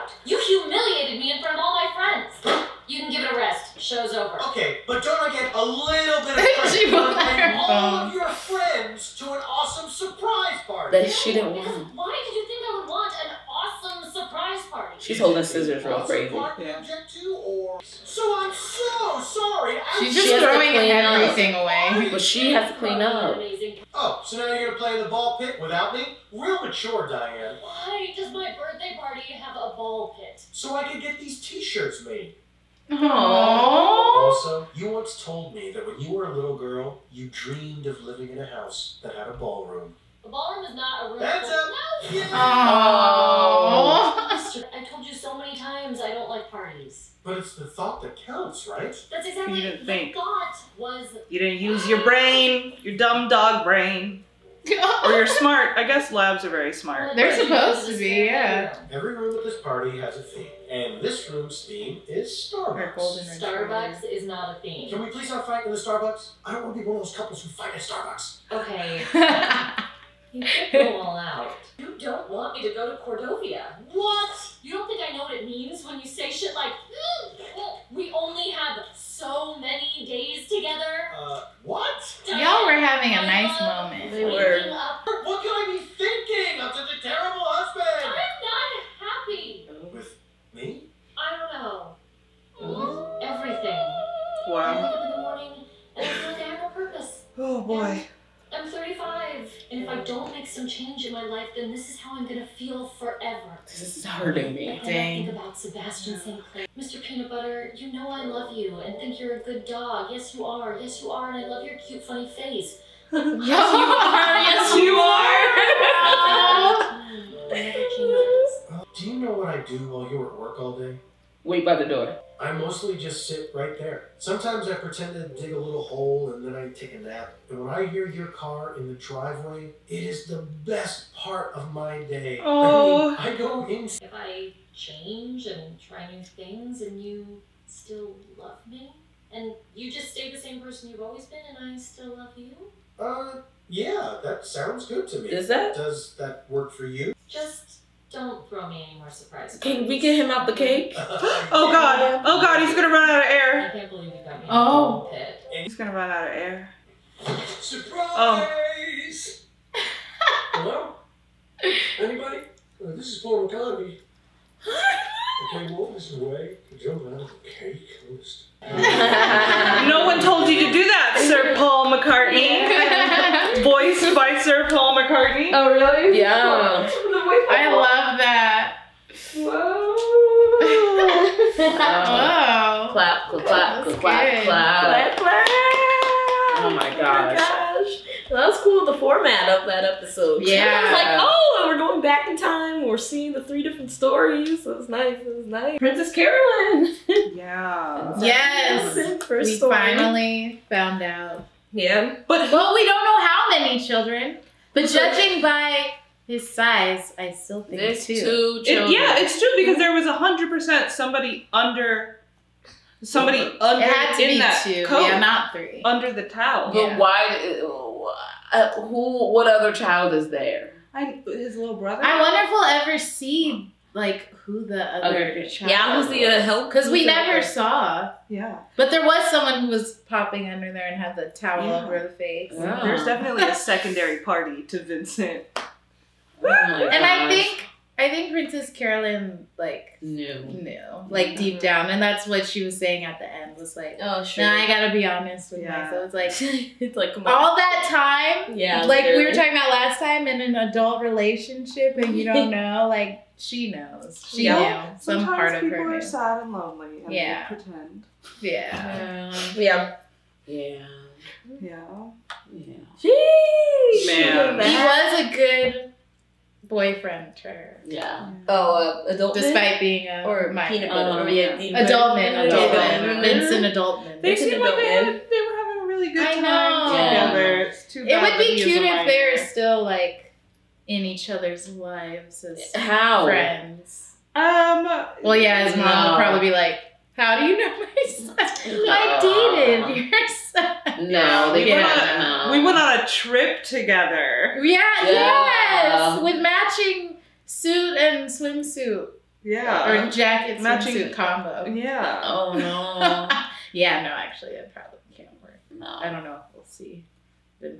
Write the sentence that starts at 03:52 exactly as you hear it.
there's definitely a secondary party to vincent oh and i think i think princess carolyn like knew knew like mm-hmm.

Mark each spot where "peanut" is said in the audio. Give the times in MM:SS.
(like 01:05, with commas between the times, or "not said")
01:47, 04:30.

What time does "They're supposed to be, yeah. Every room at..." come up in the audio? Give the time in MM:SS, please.
00:57.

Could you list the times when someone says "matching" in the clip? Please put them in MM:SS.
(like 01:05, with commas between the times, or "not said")
04:56, 05:00.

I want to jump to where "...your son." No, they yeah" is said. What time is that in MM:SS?
04:50.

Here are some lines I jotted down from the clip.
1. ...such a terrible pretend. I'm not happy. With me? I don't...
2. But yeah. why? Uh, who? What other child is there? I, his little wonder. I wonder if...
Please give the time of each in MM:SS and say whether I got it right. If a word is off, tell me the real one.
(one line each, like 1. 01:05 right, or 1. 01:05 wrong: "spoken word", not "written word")
1. 01:26 wrong: "husband", not "pretend"
2. 03:36 wrong: "brother", not "wonder".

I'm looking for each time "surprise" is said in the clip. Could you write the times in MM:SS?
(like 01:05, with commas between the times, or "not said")
00:09, 02:29, 02:37.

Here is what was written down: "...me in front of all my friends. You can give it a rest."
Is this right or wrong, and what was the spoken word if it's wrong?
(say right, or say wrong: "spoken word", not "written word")
right.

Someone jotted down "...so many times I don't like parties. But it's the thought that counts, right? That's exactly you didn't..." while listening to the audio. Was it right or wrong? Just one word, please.
right.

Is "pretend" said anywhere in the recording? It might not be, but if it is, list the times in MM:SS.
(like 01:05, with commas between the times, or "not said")
02:04, 04:17.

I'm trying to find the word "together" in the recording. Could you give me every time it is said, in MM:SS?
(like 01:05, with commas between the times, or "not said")
01:20, 04:36, 04:53.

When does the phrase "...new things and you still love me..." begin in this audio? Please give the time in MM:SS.
02:16.